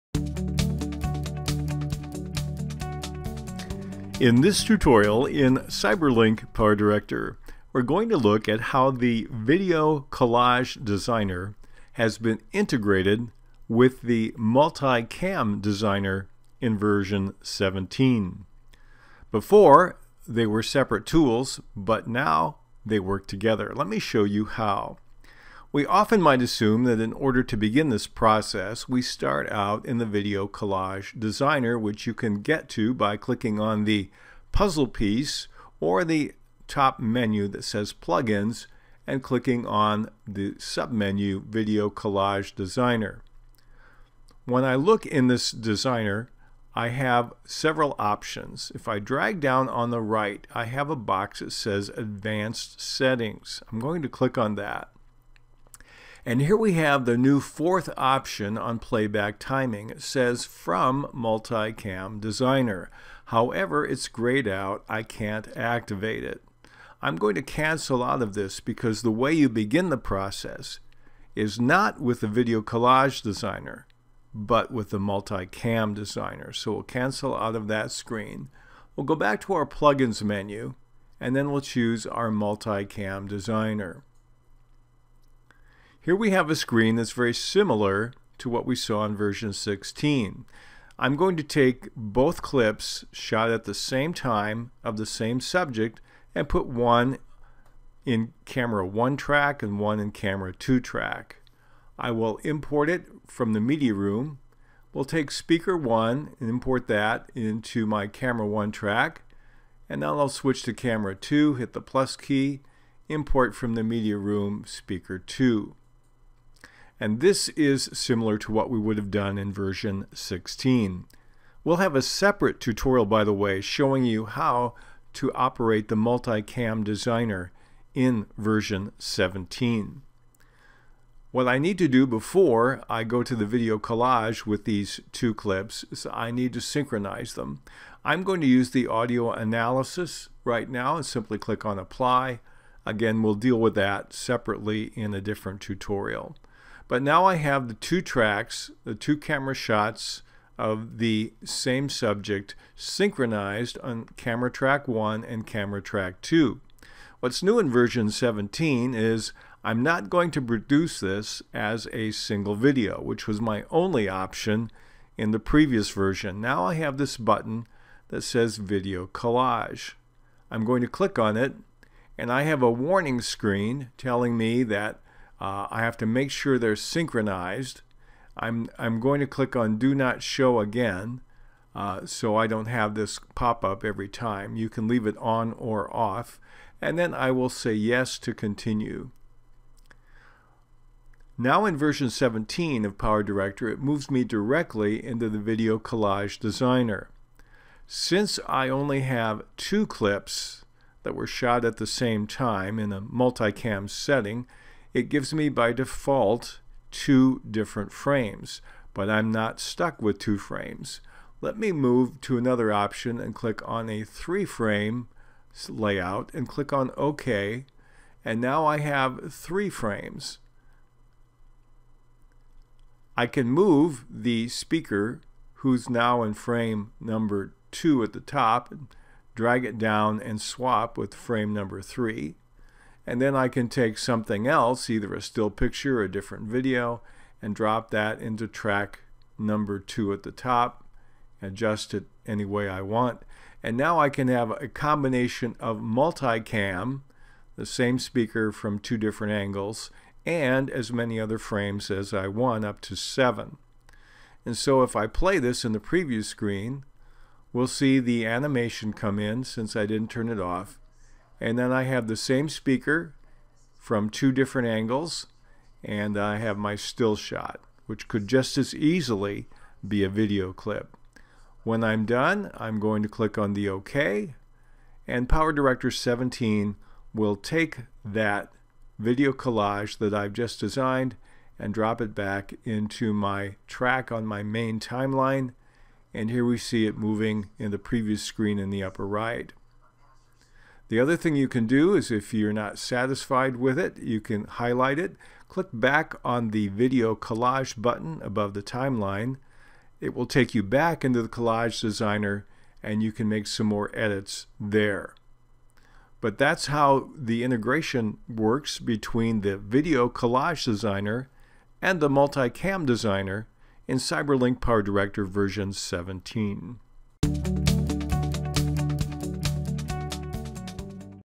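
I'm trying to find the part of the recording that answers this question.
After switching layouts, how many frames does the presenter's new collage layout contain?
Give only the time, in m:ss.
3:34.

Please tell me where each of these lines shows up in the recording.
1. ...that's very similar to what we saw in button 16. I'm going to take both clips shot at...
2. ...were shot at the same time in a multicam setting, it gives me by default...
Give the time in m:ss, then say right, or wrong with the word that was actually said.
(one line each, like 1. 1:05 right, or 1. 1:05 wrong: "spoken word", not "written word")
1. 1:26 wrong: "version", not "button"
2. 3:21 right.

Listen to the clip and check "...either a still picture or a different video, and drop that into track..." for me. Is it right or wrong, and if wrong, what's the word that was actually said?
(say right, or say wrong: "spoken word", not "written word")
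right.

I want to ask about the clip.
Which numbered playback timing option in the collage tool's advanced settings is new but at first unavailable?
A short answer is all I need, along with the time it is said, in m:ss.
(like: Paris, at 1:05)
4th, at 0:57.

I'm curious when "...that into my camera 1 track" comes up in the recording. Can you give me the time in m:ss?
1:46.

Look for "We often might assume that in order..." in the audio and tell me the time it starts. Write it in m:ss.
0:25.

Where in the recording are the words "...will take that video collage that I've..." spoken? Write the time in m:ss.
4:37.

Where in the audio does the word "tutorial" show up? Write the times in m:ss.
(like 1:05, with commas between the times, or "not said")
0:04, 2:02, 2:25.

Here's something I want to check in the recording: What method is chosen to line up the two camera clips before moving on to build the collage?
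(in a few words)
Audio analysis.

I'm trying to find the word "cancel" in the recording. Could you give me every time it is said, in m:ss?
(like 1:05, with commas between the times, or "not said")
1:07, 1:16.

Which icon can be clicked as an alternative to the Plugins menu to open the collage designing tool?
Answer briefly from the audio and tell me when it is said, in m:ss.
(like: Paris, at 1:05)
Puzzle piece, at 0:34.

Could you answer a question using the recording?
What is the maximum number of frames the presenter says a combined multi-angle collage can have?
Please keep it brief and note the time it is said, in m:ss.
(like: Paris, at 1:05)
7, at 4:12.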